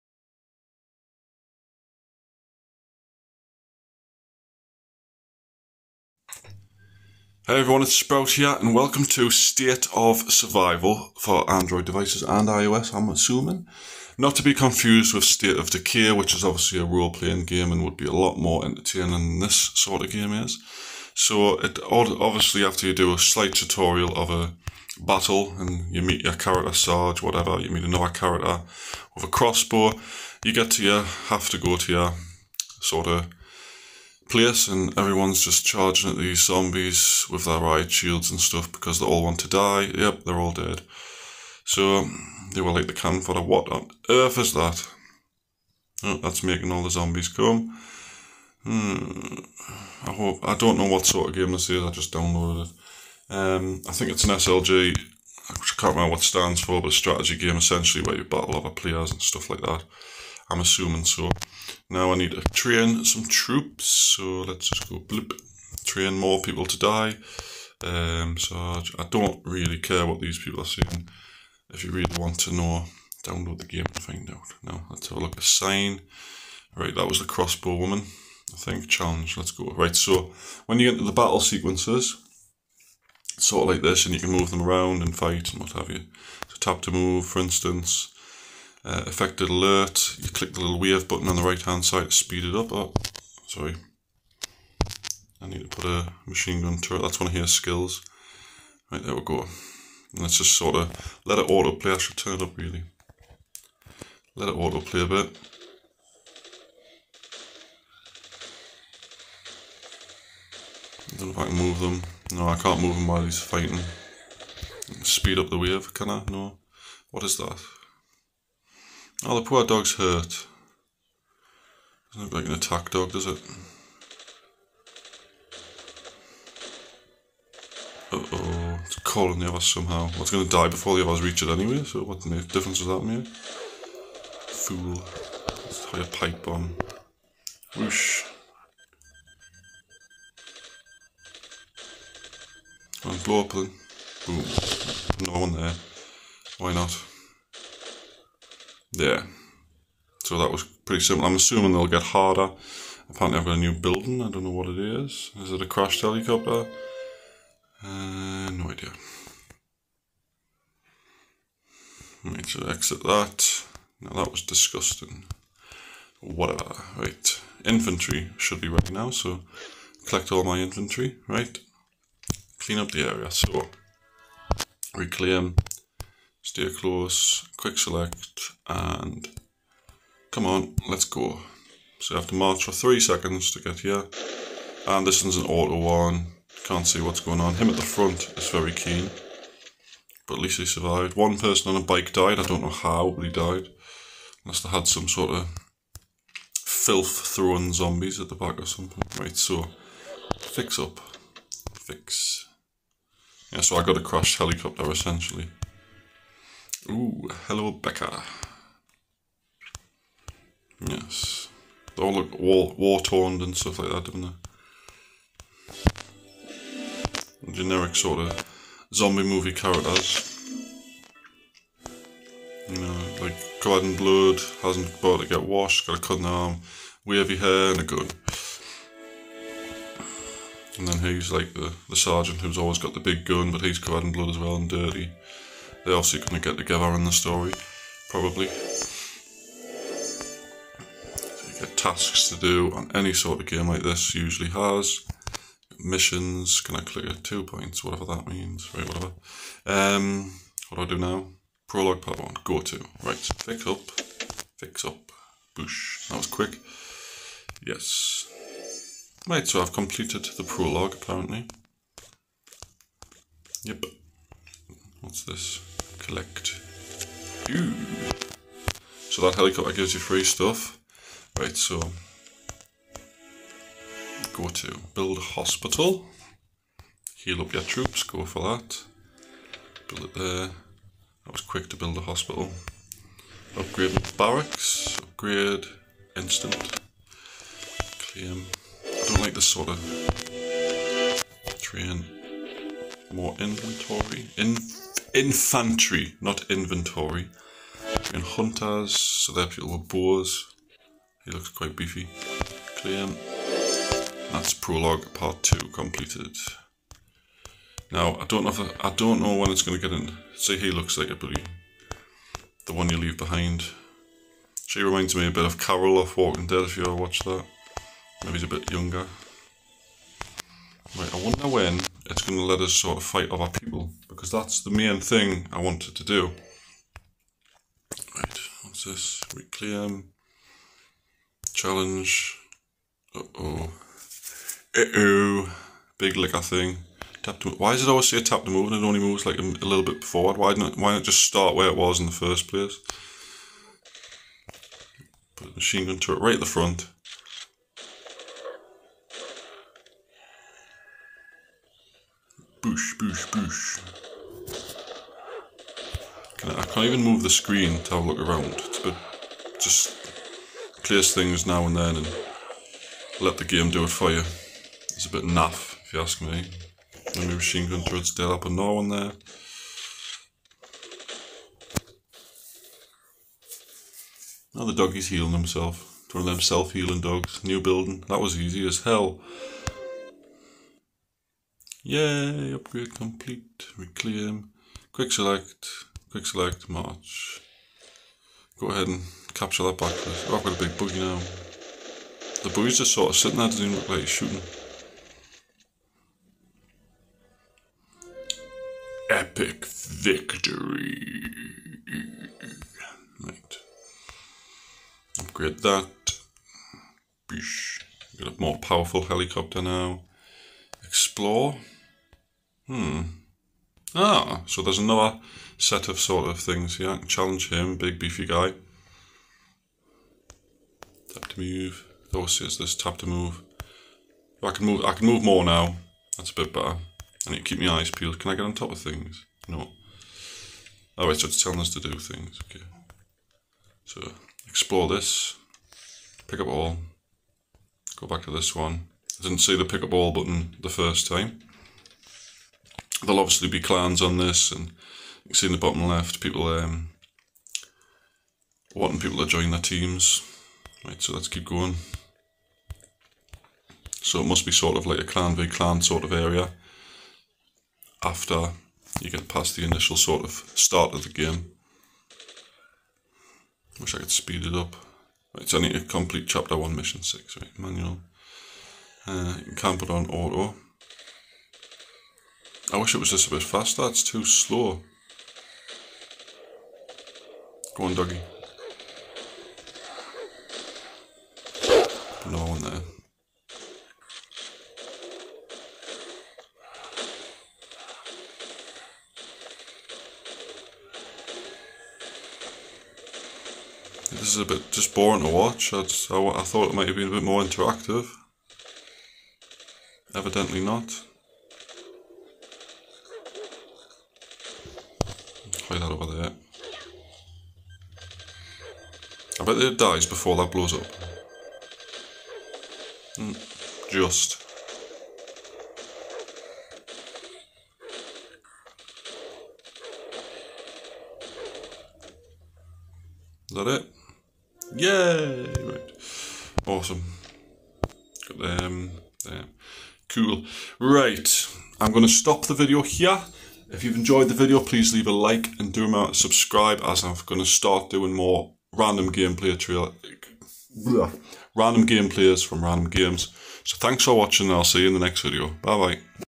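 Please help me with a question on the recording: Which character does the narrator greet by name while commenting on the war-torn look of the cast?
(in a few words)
Becca.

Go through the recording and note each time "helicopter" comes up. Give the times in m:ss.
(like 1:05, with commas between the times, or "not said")
2:36, 3:24, 4:29, 6:49.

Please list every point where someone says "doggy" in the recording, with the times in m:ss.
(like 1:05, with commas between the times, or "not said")
6:14, 7:57.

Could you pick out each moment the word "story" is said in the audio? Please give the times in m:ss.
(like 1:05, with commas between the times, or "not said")
3:57.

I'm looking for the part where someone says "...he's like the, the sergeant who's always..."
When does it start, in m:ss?
3:50.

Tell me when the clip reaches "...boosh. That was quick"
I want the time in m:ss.
4:15.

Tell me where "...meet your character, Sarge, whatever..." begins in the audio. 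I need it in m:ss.
0:26.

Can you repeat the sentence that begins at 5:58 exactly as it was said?
bit just clears things now and then and let the game do it for you.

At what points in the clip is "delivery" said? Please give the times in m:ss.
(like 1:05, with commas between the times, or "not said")
not said.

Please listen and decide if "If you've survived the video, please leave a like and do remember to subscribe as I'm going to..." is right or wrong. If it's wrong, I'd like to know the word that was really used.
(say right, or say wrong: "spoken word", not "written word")
wrong: "enjoyed", not "survived".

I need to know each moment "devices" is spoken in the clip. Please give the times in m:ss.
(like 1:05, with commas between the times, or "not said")
0:11.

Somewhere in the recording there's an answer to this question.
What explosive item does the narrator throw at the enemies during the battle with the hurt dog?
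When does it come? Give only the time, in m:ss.
2:16.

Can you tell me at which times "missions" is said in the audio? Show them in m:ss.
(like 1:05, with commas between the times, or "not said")
4:05, 7:46.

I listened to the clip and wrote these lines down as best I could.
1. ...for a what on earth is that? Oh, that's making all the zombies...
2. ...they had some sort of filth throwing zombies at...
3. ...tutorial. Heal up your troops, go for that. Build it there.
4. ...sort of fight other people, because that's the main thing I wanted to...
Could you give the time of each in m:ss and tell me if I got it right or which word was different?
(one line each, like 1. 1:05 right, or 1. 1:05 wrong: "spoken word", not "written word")
1. 0:43 right
2. 3:14 right
3. 4:35 wrong: "hospital", not "tutorial"
4. 5:22 right.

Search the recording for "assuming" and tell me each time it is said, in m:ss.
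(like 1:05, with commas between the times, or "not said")
0:13, 1:00, 2:31.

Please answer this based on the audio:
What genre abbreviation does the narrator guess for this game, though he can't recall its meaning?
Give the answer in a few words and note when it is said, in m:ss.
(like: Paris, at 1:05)
SLG, at 0:54.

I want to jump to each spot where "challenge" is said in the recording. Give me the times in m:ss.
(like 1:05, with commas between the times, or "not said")
1:18, 5:31, 6:57.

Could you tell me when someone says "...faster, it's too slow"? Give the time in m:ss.
7:53.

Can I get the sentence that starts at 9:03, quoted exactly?
So thanks for watching and I'll see you in the next video.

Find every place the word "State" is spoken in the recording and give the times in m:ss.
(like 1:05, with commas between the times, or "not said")
0:09, 0:15.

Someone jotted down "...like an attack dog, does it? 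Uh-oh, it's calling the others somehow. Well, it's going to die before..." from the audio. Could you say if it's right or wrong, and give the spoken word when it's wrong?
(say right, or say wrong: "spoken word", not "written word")
right.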